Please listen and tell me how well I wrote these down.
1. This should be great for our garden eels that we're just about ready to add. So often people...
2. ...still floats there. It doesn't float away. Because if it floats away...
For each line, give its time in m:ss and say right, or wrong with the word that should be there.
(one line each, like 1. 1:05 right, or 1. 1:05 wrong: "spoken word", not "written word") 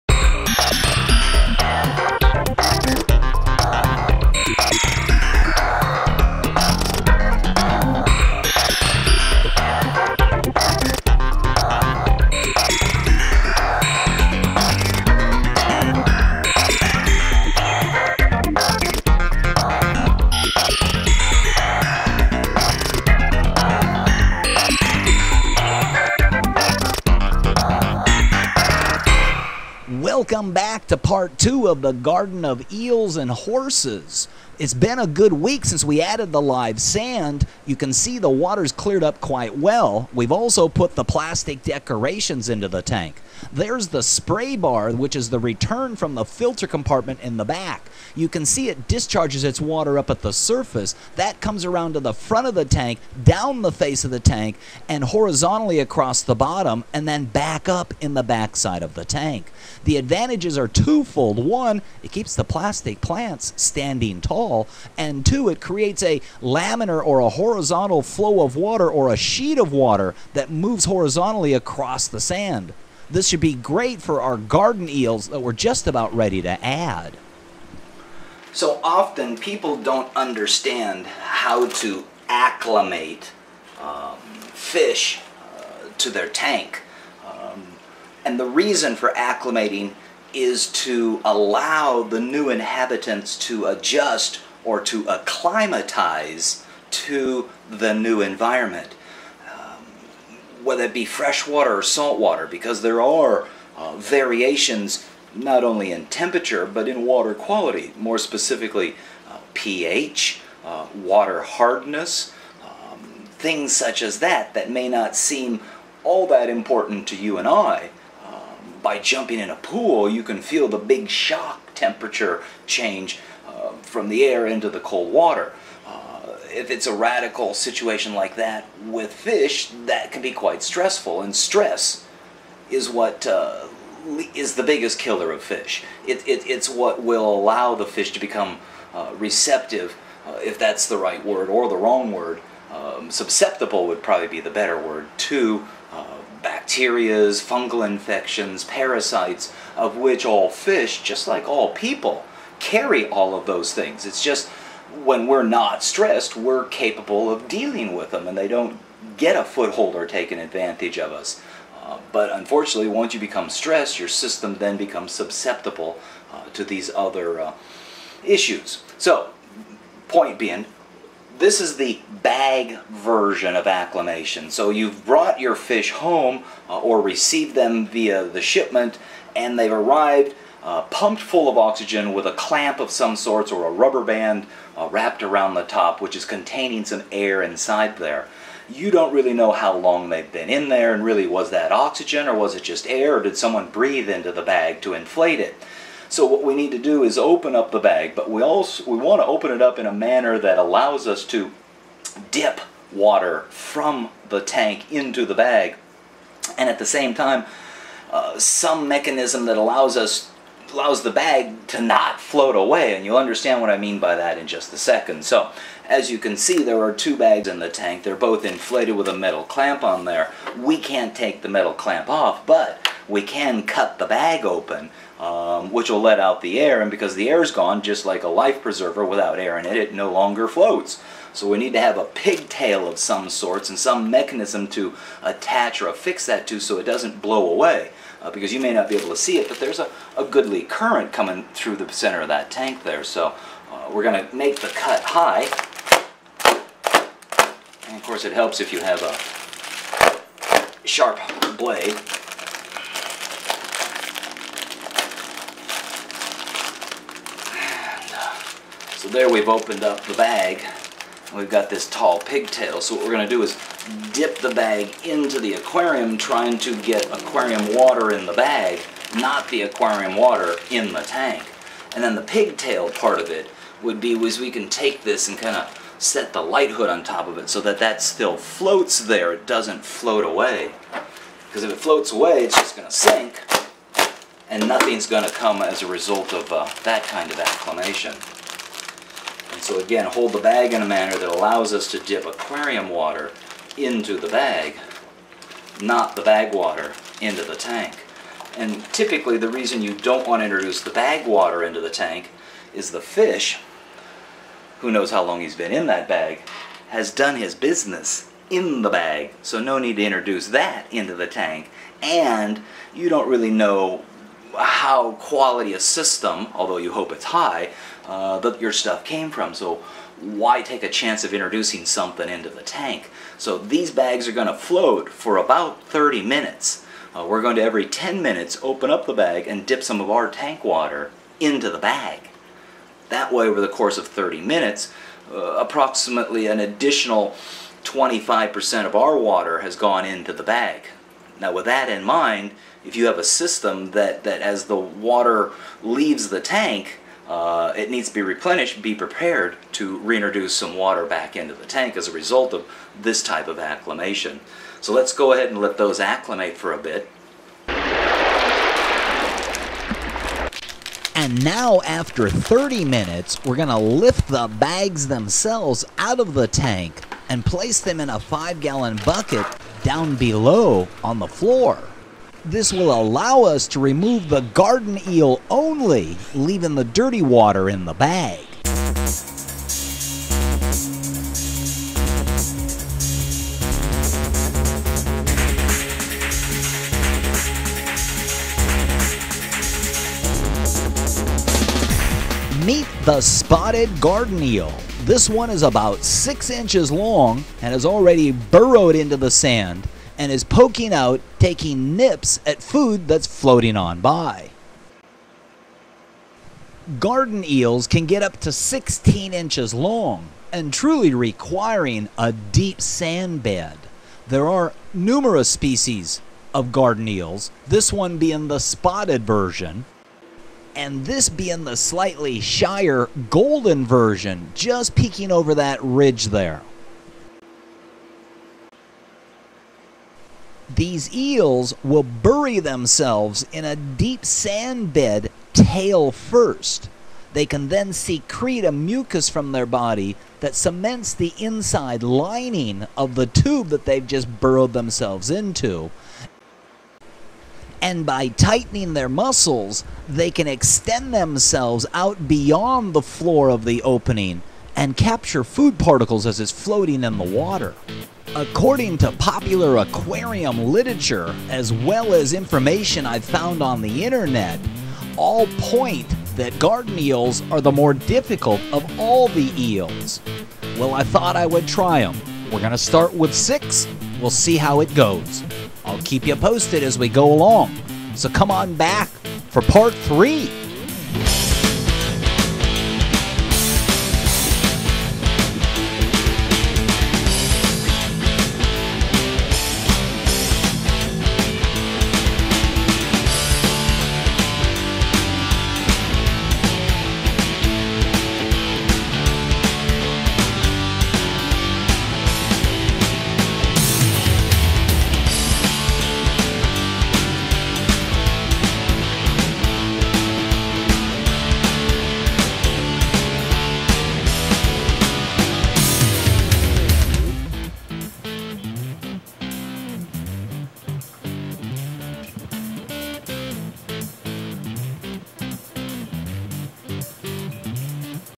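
1. 1:13 right
2. 4:38 right.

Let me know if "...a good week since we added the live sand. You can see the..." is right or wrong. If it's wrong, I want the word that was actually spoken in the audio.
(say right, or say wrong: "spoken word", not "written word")
right.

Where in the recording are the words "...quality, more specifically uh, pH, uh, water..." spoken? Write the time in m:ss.
1:47.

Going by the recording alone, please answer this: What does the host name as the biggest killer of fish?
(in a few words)
Stress.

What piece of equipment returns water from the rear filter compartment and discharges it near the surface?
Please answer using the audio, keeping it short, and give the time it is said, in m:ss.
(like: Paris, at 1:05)
Spray bar, at 0:44.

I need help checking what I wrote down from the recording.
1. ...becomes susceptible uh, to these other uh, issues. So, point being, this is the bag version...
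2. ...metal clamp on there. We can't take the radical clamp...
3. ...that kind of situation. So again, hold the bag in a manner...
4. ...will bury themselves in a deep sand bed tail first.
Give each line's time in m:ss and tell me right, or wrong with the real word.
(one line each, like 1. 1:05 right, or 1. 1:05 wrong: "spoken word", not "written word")
1. 2:44 right
2. 3:39 wrong: "metal", not "radical"
3. 4:46 wrong: "acclimation", not "situation"
4. 7:11 right.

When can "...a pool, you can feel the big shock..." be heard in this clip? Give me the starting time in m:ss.
1:59.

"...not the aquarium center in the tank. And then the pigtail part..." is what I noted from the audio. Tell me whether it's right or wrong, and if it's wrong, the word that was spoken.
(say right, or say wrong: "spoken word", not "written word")
wrong: "water", not "center".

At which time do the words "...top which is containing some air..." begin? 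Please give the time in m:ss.
3:05.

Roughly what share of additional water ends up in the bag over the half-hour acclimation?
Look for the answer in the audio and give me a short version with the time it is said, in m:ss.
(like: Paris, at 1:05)
25%, at 5:37.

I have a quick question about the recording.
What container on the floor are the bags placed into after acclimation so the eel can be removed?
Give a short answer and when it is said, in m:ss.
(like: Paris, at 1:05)
Five gallon bucket, at 6:08.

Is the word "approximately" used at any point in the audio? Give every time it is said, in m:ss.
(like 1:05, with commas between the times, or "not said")
5:35.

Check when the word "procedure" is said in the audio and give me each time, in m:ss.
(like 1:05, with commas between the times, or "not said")
not said.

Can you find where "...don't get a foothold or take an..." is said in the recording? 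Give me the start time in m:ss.
2:38.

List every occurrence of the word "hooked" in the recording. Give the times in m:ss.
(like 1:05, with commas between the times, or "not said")
not said.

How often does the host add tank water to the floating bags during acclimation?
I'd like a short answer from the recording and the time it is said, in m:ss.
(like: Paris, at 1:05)
Every 10 minutes, at 5:27.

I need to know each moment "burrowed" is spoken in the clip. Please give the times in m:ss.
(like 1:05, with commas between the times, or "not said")
6:38, 7:24.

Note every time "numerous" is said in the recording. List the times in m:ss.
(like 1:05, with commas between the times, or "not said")
6:54.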